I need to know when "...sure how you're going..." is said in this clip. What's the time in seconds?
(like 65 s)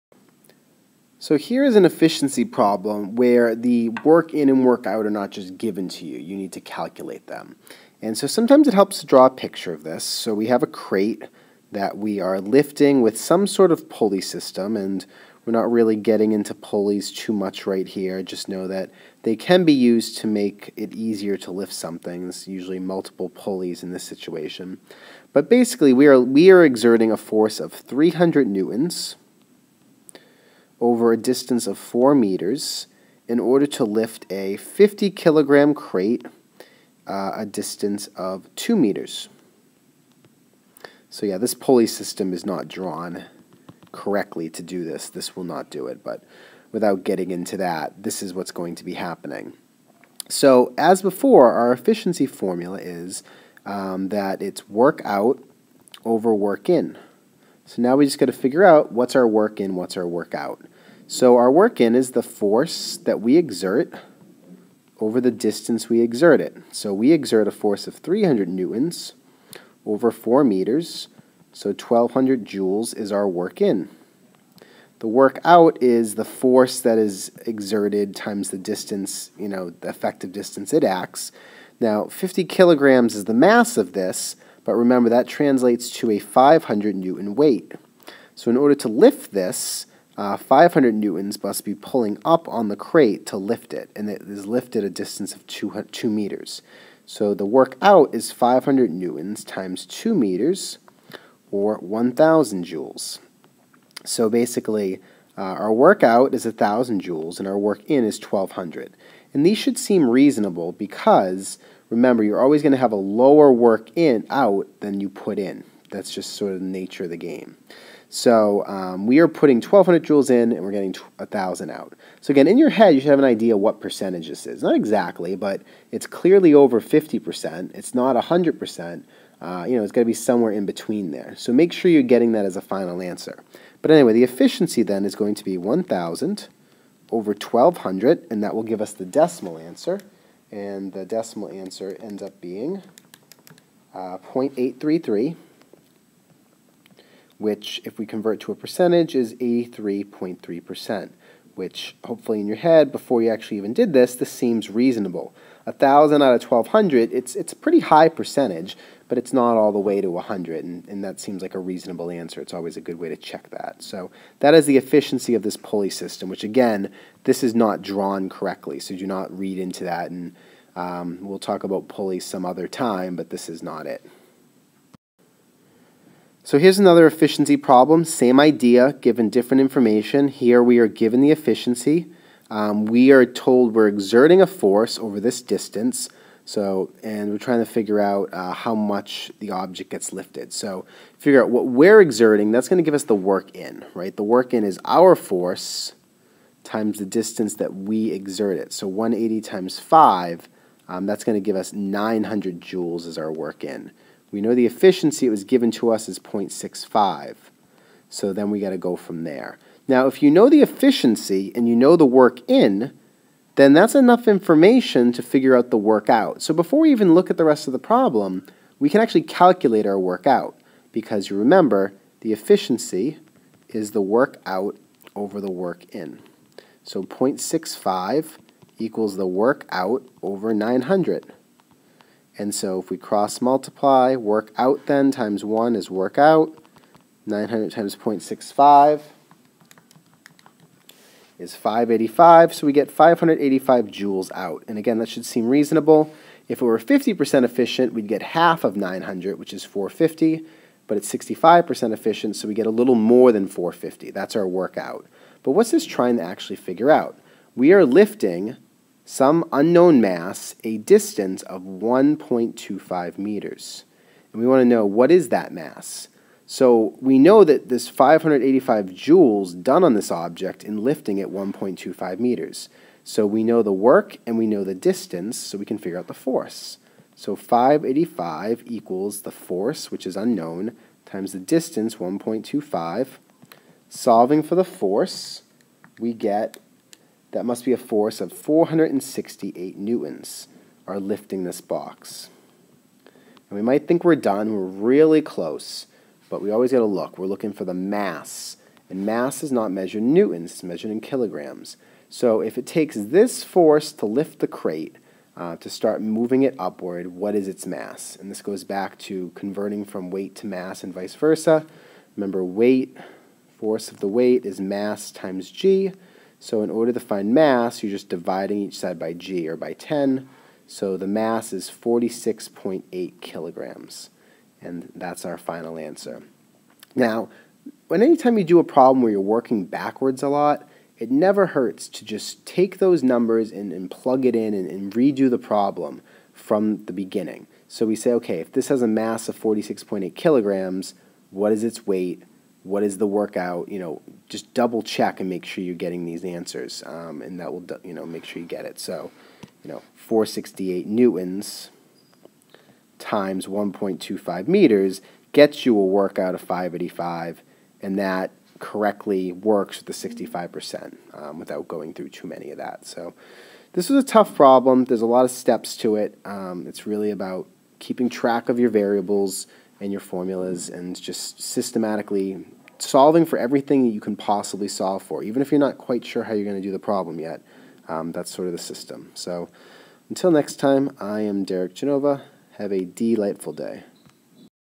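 376 s.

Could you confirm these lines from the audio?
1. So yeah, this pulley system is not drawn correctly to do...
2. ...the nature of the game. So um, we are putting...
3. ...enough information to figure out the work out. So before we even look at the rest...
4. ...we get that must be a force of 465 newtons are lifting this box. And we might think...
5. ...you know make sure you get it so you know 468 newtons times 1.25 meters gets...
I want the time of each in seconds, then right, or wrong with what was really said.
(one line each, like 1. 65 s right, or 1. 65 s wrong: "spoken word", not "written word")
1. 41 s right
2. 116 s right
3. 213 s right
4. 285 s wrong: "468", not "465"
5. 347 s right.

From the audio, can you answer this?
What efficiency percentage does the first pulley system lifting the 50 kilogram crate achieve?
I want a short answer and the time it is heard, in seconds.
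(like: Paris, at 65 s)
83.3%, at 149 s.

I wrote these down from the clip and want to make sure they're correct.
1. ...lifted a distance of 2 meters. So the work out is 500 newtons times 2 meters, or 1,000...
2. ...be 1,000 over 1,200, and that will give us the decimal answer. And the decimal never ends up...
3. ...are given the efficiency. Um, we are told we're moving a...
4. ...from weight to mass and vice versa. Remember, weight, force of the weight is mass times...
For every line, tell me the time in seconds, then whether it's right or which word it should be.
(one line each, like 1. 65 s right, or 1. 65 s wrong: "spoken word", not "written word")
1. 94 s right
2. 135 s wrong: "answer", not "never"
3. 180 s wrong: "exerting", not "moving"
4. 309 s right.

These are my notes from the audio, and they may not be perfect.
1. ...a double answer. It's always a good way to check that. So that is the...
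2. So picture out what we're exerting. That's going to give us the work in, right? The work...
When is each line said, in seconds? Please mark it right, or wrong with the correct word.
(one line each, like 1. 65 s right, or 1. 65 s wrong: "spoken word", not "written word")
1. 161 s wrong: "reasonable", not "double"
2. 190 s wrong: "figure", not "picture".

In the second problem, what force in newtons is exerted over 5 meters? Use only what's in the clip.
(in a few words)
180.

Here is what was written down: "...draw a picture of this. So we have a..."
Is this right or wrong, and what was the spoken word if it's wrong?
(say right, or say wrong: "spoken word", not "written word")
right.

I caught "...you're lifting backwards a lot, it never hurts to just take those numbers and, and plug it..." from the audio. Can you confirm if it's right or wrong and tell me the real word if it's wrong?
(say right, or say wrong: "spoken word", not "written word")
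wrong: "working", not "lifting".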